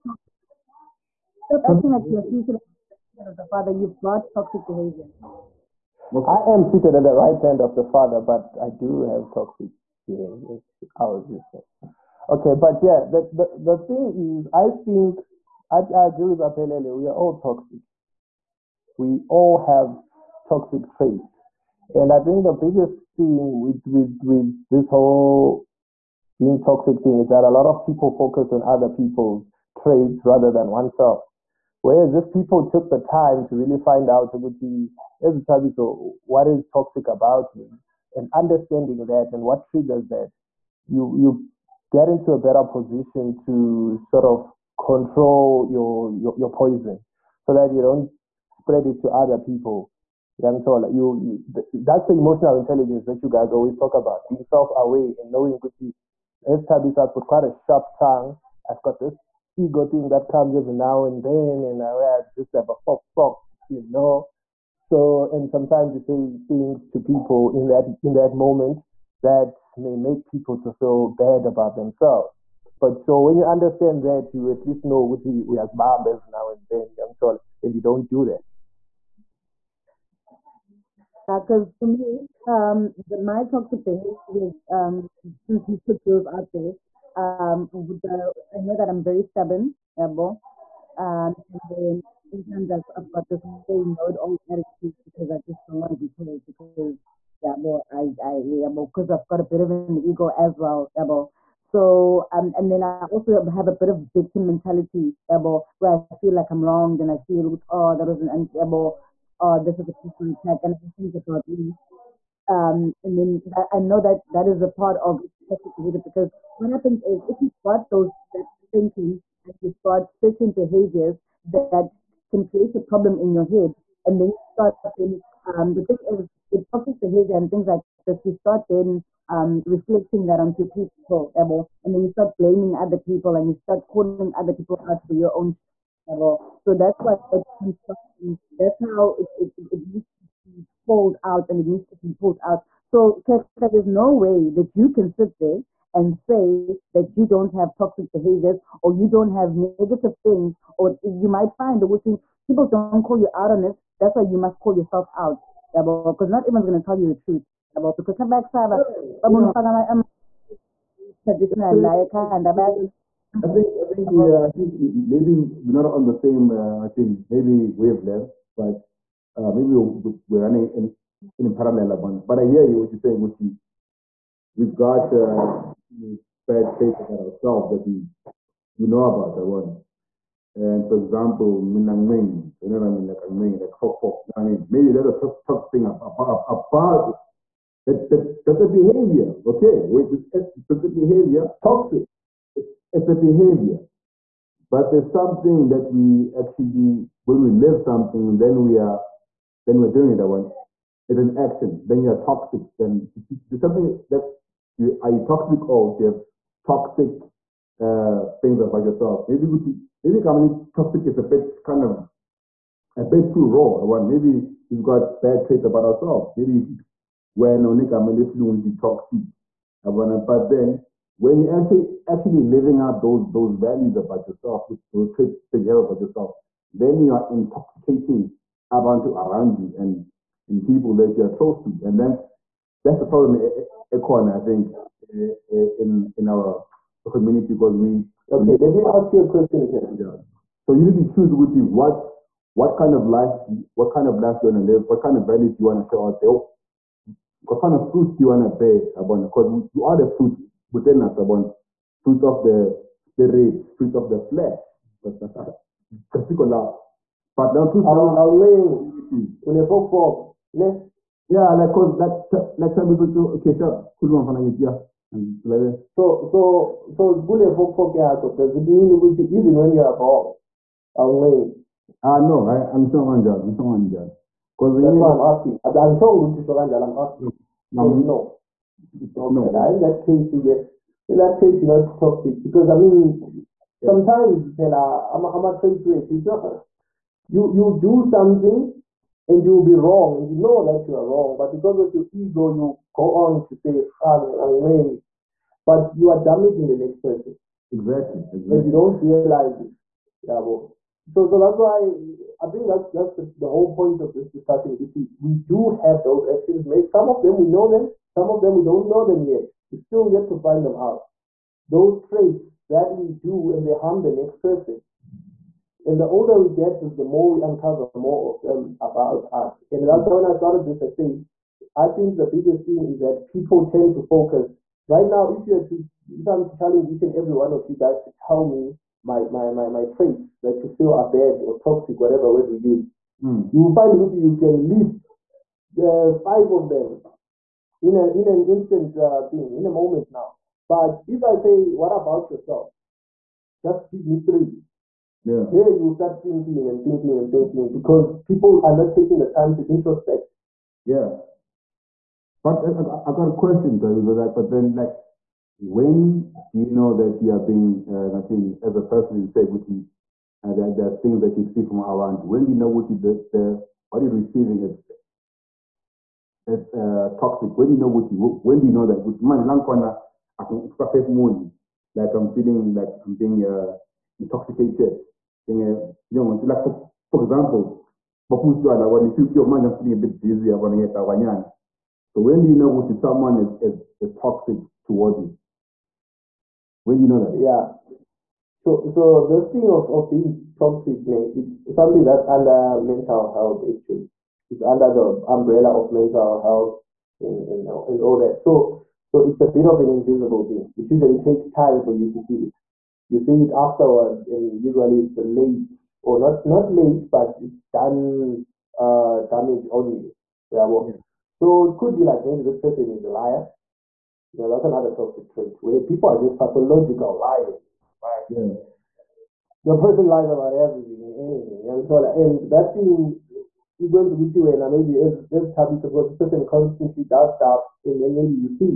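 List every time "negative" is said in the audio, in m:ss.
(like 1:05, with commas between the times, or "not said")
2:29.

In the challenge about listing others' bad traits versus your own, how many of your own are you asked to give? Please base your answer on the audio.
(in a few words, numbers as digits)
3.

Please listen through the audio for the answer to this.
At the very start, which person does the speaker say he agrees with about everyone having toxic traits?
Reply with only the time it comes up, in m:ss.
0:16.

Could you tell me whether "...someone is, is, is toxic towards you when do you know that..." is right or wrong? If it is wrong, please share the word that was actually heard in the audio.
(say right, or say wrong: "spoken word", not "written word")
right.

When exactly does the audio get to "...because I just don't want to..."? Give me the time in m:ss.
1:35.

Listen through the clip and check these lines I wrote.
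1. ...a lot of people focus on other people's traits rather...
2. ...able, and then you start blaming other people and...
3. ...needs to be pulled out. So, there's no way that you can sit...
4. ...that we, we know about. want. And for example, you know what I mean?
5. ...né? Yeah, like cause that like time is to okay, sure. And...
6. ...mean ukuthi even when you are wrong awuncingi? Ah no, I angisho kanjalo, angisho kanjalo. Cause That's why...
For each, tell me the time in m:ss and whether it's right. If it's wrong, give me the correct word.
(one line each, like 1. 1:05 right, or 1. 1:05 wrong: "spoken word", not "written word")
1. 0:27 right
2. 2:11 right
3. 2:21 right
4. 2:57 right
5. 4:20 right
6. 4:28 right.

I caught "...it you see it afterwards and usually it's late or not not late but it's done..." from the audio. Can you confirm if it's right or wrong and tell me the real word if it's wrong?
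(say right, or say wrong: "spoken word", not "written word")
right.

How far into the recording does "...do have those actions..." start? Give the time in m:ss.
5:05.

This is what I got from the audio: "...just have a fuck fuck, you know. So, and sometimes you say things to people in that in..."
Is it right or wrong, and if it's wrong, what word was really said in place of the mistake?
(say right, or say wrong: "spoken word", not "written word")
right.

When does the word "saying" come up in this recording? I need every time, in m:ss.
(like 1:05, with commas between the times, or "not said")
0:11, 2:52.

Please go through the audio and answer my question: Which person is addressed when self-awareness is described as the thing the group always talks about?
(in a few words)
Young Tola.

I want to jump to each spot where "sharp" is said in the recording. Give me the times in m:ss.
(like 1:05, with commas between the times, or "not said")
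0:57.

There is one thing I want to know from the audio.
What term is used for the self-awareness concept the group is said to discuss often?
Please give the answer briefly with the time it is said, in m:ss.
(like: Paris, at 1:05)
emotional intelligence, at 0:52.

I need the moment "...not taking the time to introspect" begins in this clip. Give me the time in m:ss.
5:48.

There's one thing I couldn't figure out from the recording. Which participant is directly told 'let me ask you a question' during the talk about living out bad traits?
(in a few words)
Ken.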